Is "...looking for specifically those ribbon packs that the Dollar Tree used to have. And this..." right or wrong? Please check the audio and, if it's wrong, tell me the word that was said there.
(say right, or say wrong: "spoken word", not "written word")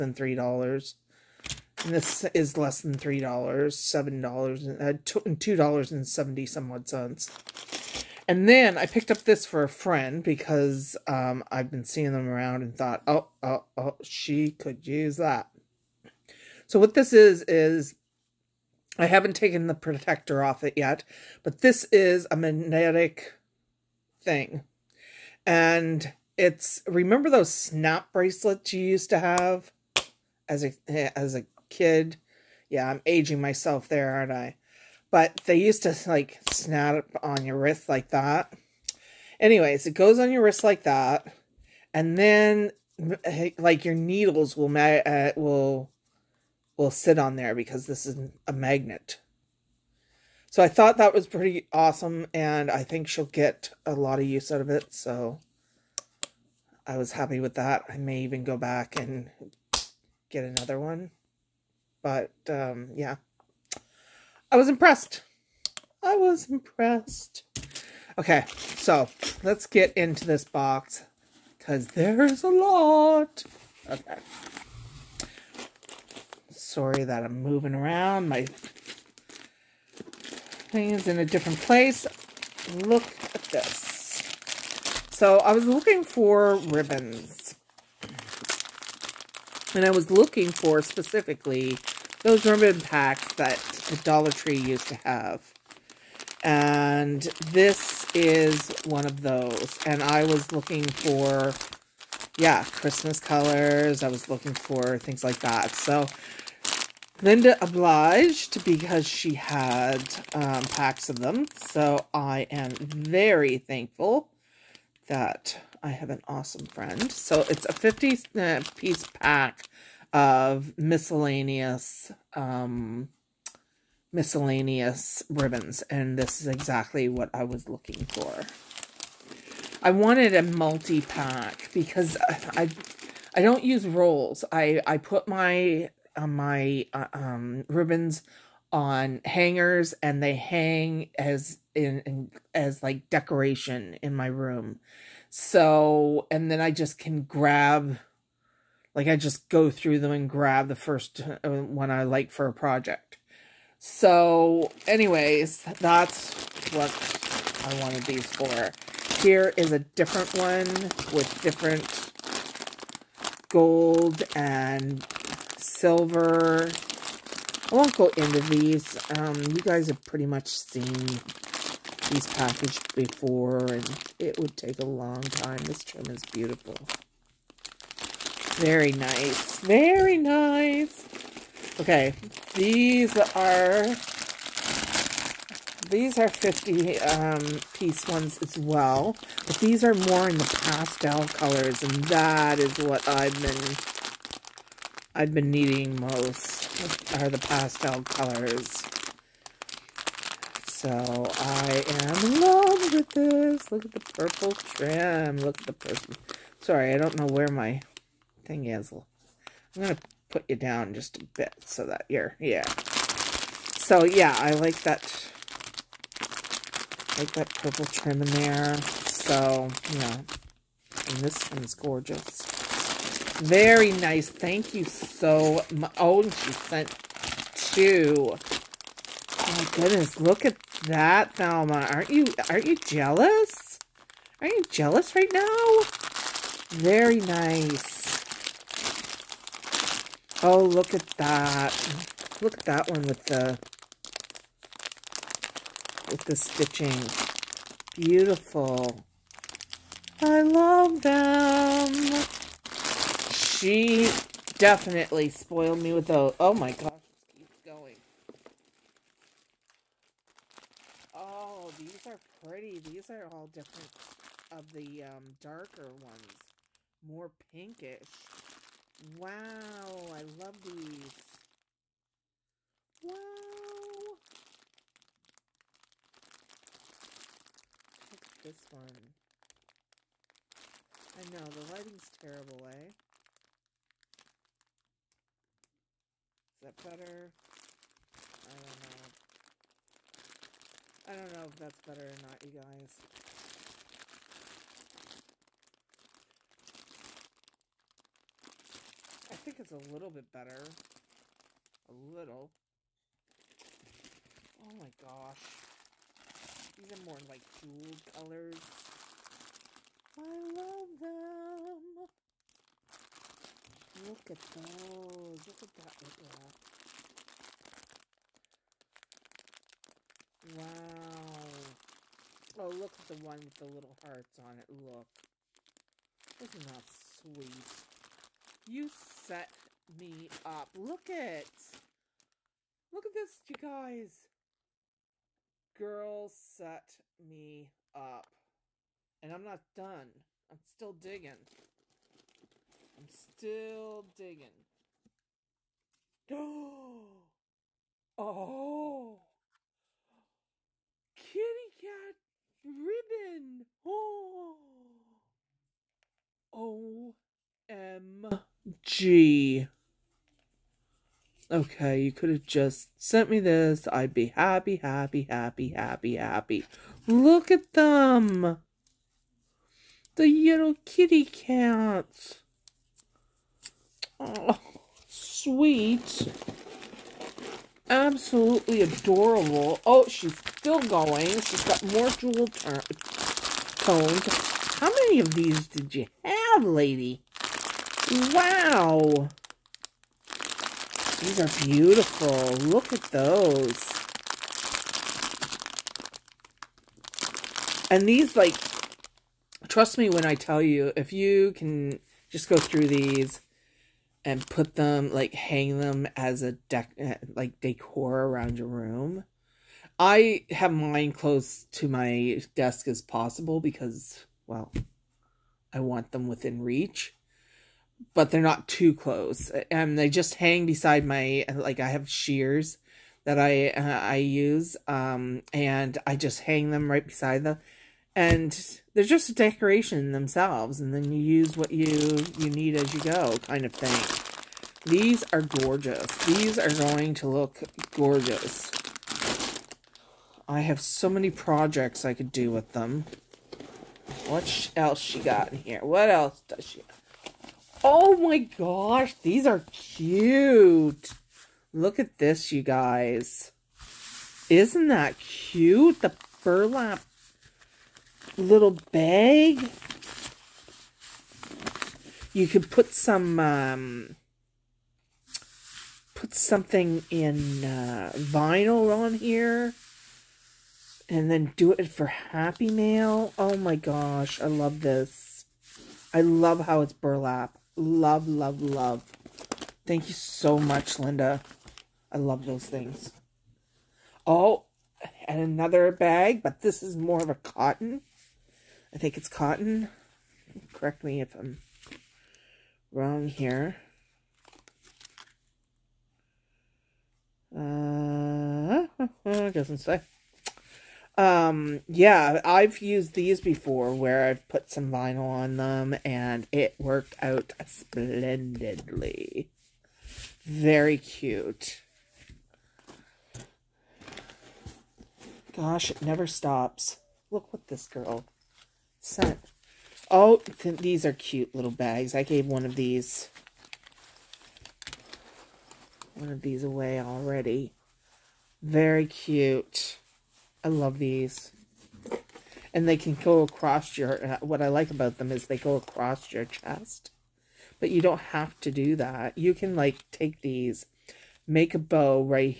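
right.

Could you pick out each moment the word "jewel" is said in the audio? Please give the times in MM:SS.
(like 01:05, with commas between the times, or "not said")
05:07, 06:22.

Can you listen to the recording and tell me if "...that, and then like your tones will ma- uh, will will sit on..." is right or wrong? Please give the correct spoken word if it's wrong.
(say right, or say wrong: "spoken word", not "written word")
wrong: "needles", not "tones".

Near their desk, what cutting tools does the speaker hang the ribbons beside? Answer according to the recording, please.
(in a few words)
Shears.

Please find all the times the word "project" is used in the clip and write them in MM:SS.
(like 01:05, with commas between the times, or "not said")
02:32, 07:21.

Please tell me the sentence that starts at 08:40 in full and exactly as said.
Oh, th these are cute little bags.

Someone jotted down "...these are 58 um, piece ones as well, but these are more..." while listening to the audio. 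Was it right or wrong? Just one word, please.
wrong.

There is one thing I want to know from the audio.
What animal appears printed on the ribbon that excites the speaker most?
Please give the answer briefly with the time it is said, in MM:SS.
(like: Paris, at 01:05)
Kitty cats, at 05:51.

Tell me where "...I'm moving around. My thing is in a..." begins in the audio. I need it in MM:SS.
01:17.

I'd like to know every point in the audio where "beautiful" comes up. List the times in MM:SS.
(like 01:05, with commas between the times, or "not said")
02:56, 04:07, 06:31.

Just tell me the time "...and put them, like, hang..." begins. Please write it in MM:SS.
06:44.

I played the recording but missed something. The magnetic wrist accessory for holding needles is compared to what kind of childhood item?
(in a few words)
Snap bracelets.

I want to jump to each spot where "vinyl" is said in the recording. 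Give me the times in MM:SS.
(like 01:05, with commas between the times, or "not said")
07:48, 08:24.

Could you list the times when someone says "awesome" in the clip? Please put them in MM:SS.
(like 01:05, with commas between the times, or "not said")
00:51, 01:56.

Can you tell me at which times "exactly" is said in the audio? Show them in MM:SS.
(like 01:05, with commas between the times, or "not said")
02:06.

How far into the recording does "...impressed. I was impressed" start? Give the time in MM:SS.
01:04.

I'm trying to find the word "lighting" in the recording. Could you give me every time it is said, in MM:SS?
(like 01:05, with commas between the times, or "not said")
04:41.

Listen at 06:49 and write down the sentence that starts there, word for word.
I have mine close to my desk as possible because, well, I want them within reach but they're not too close.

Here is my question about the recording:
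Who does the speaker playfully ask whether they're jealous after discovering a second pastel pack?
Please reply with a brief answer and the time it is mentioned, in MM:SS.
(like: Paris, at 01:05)
Thelma, at 03:51.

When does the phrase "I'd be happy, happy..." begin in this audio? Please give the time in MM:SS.
06:03.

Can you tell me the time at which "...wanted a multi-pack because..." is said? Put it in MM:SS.
02:09.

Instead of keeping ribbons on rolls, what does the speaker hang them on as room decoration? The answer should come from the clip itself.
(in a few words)
Hangers.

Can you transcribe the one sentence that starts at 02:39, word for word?
Here is a different one with different gold and silver.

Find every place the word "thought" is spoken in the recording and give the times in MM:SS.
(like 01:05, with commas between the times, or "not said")
00:12, 00:50.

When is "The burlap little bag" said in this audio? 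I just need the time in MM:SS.
07:36.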